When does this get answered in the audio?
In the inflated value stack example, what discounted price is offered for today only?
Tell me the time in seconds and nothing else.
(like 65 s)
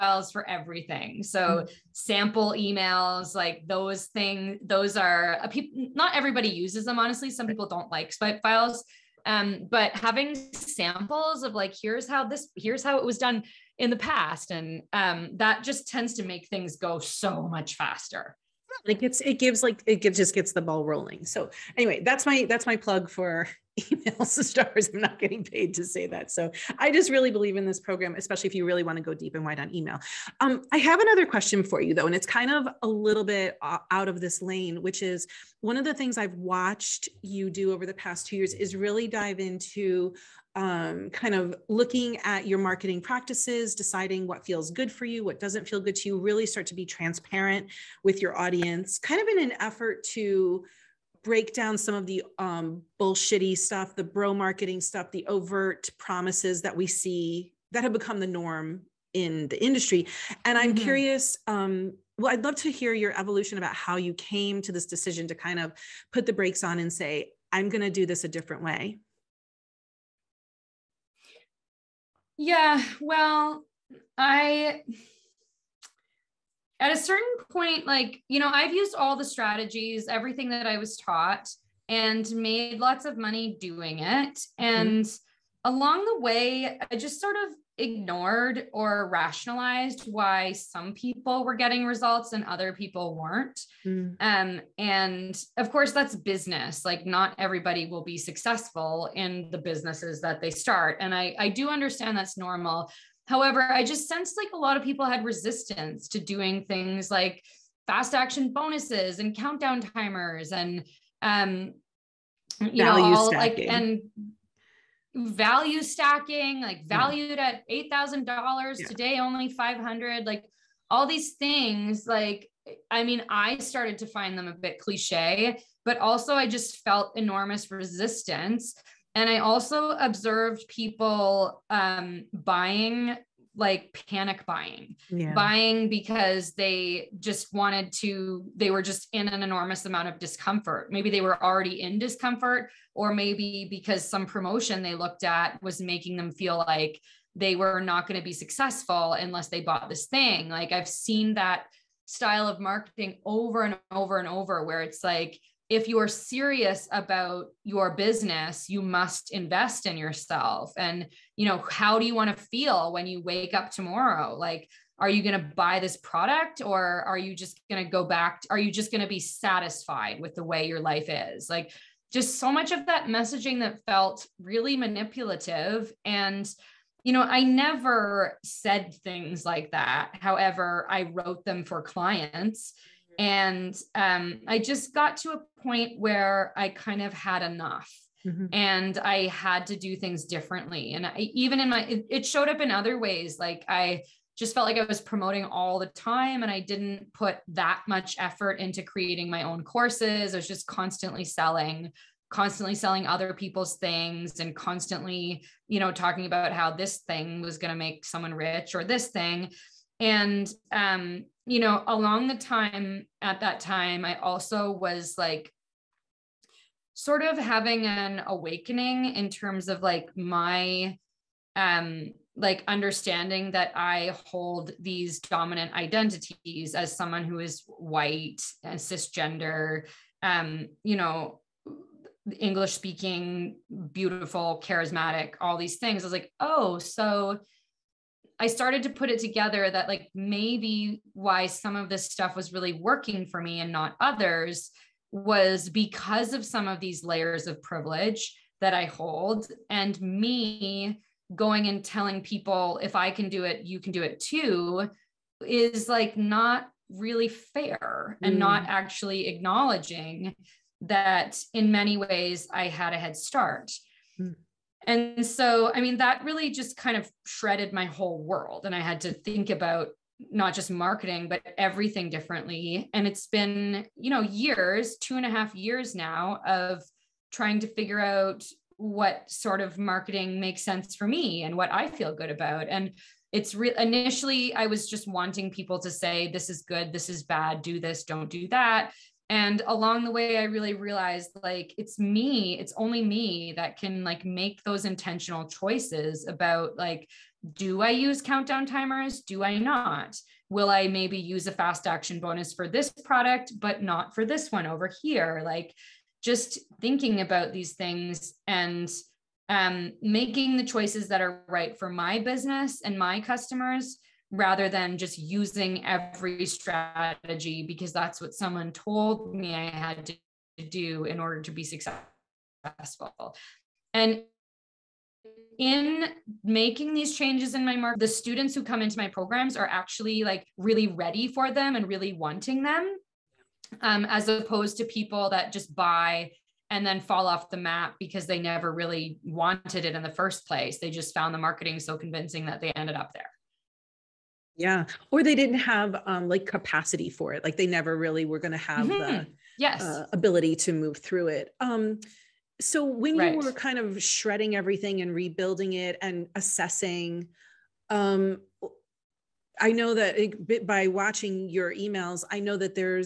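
119 s.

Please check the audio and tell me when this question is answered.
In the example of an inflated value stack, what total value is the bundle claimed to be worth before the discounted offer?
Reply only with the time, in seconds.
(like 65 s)
117 s.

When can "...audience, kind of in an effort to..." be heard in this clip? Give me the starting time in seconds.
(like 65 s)
48 s.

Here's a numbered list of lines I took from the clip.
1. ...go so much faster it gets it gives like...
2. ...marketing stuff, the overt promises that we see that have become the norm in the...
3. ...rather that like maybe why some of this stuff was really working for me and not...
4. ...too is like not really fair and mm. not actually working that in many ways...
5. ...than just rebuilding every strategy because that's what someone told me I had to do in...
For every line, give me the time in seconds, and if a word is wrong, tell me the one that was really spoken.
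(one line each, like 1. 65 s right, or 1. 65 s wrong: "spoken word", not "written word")
1. 16 s right
2. 54 s right
3. 239 s wrong: "together", not "rather"
4. 254 s wrong: "acknowledging", not "working"
5. 314 s wrong: "using", not "rebuilding".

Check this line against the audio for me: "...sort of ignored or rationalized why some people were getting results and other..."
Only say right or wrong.
right.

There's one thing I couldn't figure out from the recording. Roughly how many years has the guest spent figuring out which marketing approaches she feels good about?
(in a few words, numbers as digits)
2.5 years.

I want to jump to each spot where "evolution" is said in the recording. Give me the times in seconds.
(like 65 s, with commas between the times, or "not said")
63 s.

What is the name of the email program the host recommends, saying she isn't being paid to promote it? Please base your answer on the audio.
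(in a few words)
Emails to stars.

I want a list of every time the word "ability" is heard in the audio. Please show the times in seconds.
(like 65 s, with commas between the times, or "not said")
350 s.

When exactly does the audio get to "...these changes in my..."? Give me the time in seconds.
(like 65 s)
326 s.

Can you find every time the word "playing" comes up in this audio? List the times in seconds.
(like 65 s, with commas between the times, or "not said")
not said.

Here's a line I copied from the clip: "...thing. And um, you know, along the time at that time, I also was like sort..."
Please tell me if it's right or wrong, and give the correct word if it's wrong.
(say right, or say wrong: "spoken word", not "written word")
right.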